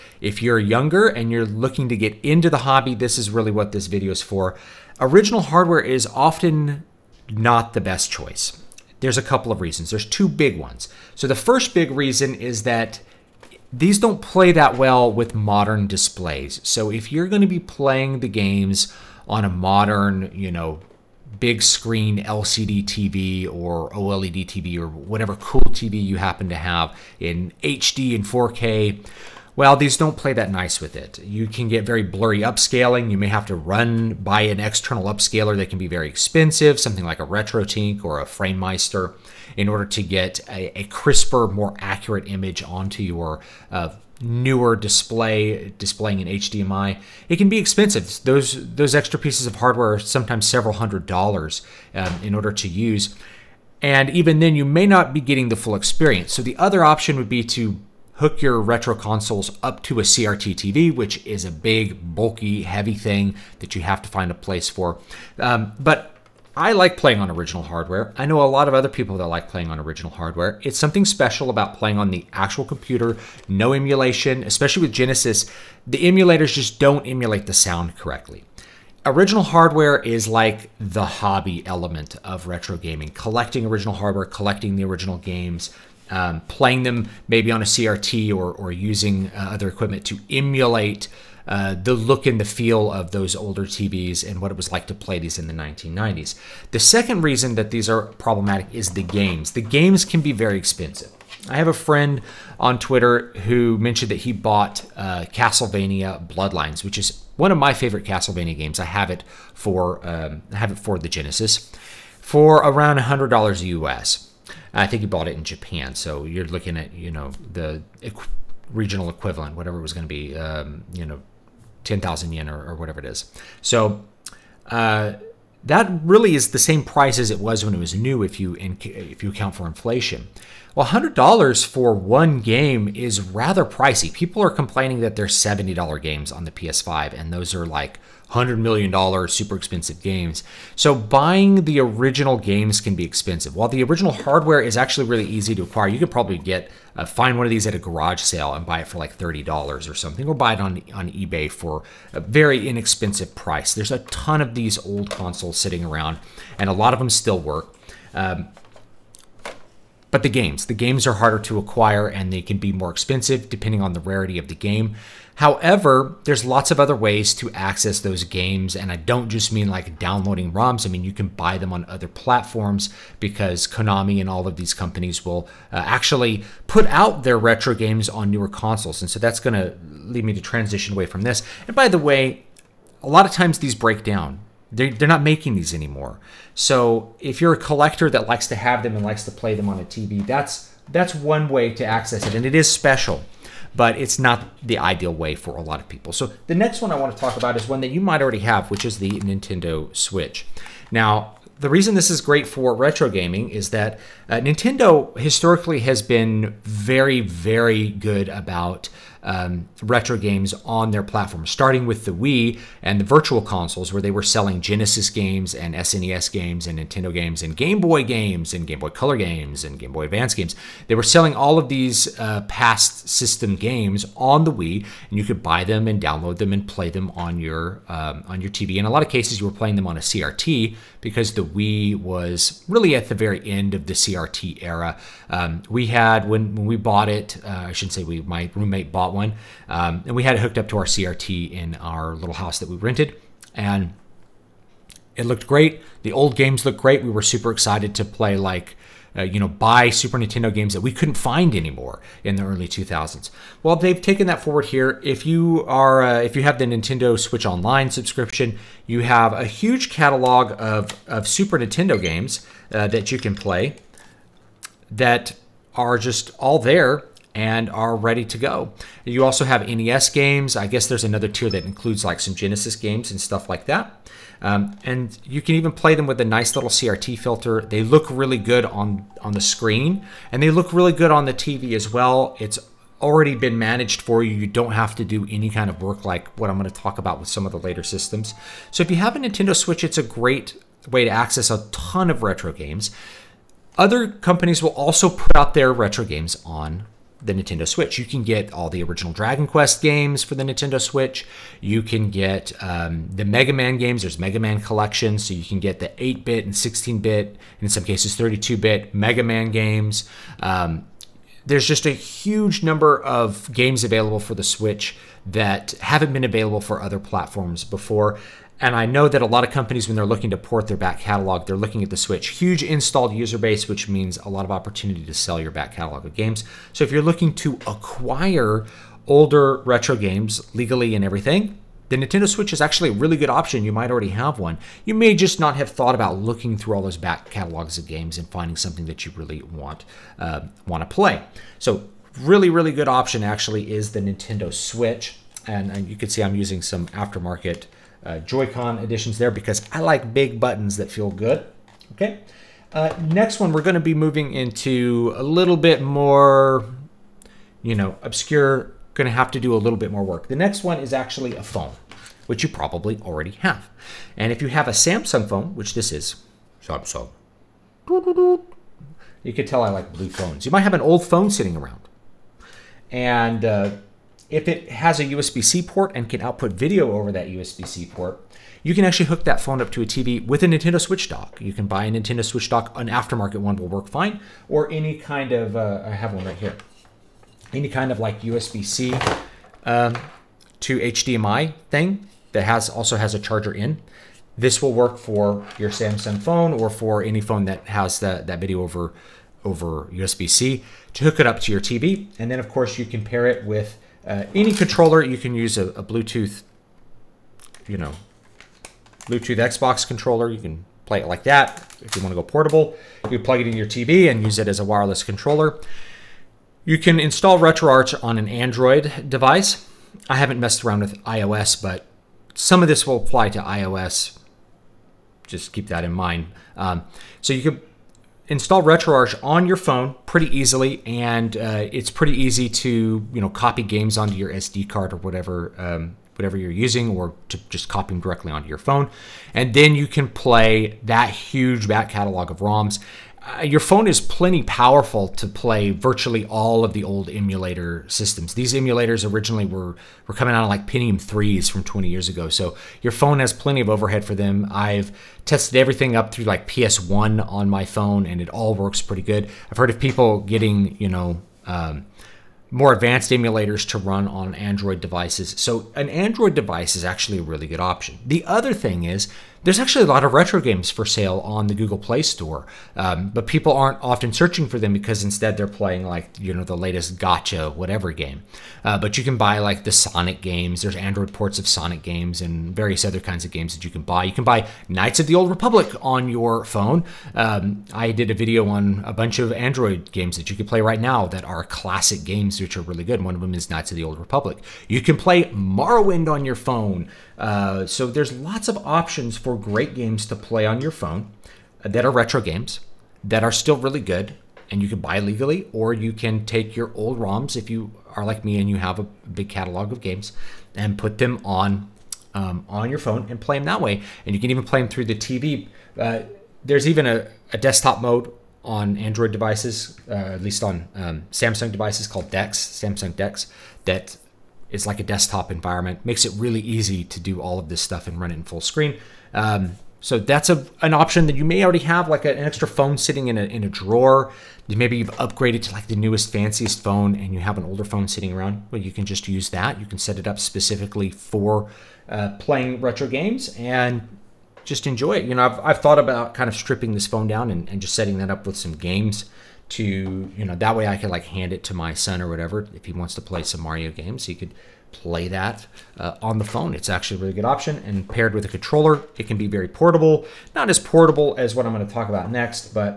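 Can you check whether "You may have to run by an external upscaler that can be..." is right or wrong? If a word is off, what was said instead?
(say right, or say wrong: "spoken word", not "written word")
right.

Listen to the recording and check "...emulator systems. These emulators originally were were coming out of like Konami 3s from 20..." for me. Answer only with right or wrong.
wrong.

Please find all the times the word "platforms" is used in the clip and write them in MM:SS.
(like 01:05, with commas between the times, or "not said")
02:52, 03:31, 05:16.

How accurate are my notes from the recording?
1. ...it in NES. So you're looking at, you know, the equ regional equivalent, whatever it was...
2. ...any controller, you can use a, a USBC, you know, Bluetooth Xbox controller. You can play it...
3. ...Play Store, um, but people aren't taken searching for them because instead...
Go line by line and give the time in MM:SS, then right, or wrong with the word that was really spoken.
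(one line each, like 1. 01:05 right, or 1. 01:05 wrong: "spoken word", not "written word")
1. 01:55 wrong: "Japan", not "NES"
2. 06:44 wrong: "Bluetooth", not "USBC"
3. 07:51 wrong: "often", not "taken".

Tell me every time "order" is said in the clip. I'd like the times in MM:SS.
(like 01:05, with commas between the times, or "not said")
00:39, 00:52.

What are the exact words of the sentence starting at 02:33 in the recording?
There's a ton of these old consoles sitting around, and a lot of them still work.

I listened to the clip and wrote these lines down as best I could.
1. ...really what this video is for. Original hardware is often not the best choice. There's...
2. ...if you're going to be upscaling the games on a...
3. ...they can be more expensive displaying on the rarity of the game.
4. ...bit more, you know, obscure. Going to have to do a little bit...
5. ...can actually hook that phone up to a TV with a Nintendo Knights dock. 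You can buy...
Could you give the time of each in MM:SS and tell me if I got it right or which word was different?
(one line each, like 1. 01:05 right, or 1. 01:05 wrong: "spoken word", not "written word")
1. 00:03 right
2. 00:16 wrong: "playing", not "upscaling"
3. 02:42 wrong: "depending", not "displaying"
4. 05:55 right
5. 06:18 wrong: "Switch", not "Knights".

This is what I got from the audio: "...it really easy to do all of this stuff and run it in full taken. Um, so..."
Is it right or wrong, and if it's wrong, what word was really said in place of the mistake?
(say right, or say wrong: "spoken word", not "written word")
wrong: "screen", not "taken".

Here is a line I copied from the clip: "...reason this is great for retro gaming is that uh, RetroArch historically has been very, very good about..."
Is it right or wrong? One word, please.
wrong.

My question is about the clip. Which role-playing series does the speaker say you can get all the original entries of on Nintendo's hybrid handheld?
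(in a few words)
Dragon Quest.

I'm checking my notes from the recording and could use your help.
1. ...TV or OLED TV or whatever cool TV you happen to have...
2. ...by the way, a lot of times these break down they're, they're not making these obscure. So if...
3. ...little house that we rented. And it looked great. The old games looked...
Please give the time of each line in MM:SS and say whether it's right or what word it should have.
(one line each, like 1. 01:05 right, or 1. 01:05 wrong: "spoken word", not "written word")
1. 00:22 right
2. 03:01 wrong: "anymore", not "obscure"
3. 04:02 right.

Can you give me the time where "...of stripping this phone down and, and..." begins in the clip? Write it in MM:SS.
09:06.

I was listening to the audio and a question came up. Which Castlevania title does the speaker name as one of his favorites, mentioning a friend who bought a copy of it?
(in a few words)
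Castlevania Bloodlines.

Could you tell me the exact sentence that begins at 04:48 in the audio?
So if you have a Nintendo Switch, it's a great way to access a ton of retro games.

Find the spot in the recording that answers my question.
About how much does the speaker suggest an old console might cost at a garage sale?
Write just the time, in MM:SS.
02:29.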